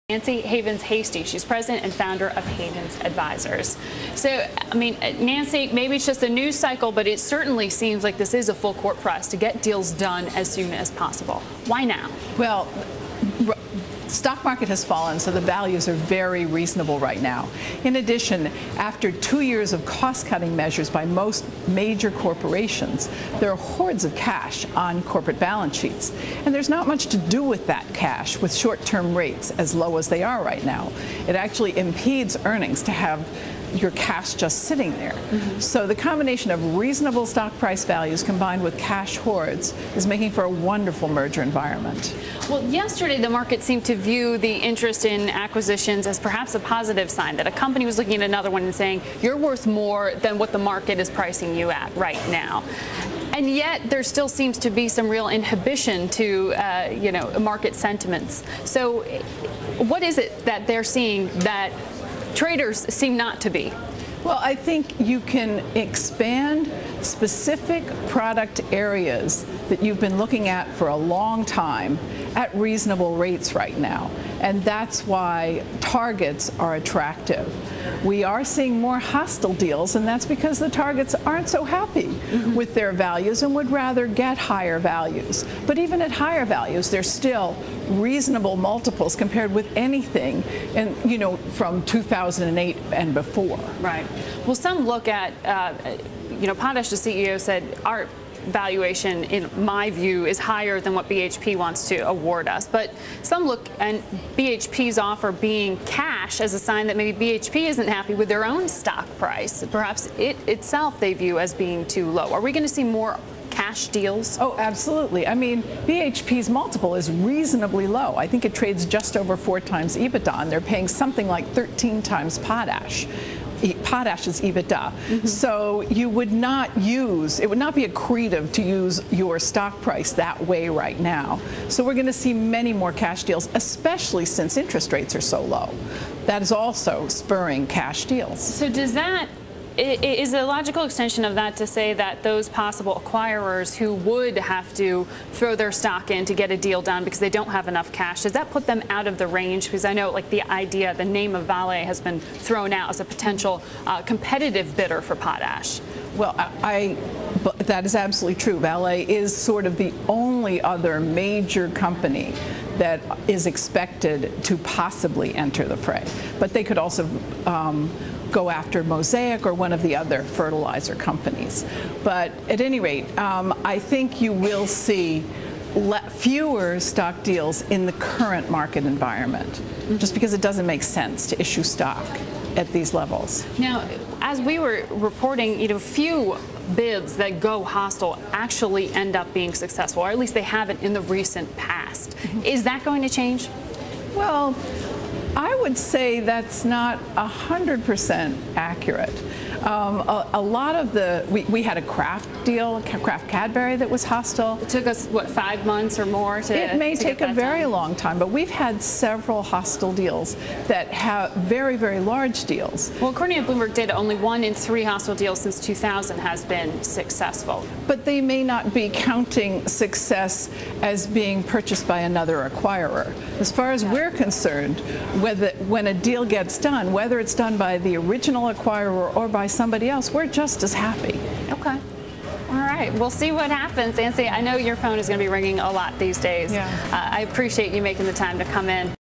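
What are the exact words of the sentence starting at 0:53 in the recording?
And yet, there still seems to be some real inhibition to, uh, you know, market sentiments.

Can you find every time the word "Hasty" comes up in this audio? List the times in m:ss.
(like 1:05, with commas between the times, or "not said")
0:00.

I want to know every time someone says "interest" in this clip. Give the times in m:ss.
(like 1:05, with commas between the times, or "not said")
0:44, 2:14.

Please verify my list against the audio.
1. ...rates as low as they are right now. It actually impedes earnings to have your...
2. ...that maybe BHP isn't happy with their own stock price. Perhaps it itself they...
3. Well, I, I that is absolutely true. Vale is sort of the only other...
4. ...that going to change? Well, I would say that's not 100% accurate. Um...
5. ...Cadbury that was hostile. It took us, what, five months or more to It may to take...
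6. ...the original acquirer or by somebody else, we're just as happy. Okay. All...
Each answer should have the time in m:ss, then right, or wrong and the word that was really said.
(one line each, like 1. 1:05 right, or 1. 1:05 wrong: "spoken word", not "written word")
1. 0:29 right
2. 1:46 right
3. 2:36 right
4. 3:12 right
5. 3:23 right
6. 3:47 right.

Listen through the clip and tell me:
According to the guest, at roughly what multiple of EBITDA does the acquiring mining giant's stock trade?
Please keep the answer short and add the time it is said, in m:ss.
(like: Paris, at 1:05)
just over 4 times, at 1:58.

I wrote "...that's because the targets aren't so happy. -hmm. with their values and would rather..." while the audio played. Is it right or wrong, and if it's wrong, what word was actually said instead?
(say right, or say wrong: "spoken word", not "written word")
right.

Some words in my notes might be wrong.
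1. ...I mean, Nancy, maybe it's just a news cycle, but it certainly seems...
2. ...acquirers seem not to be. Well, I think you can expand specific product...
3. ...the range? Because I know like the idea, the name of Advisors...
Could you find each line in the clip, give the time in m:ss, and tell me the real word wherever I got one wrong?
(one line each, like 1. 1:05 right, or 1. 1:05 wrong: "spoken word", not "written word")
1. 0:04 right
2. 1:02 wrong: "traders", not "acquirers"
3. 2:29 wrong: "Vale", not "Advisors".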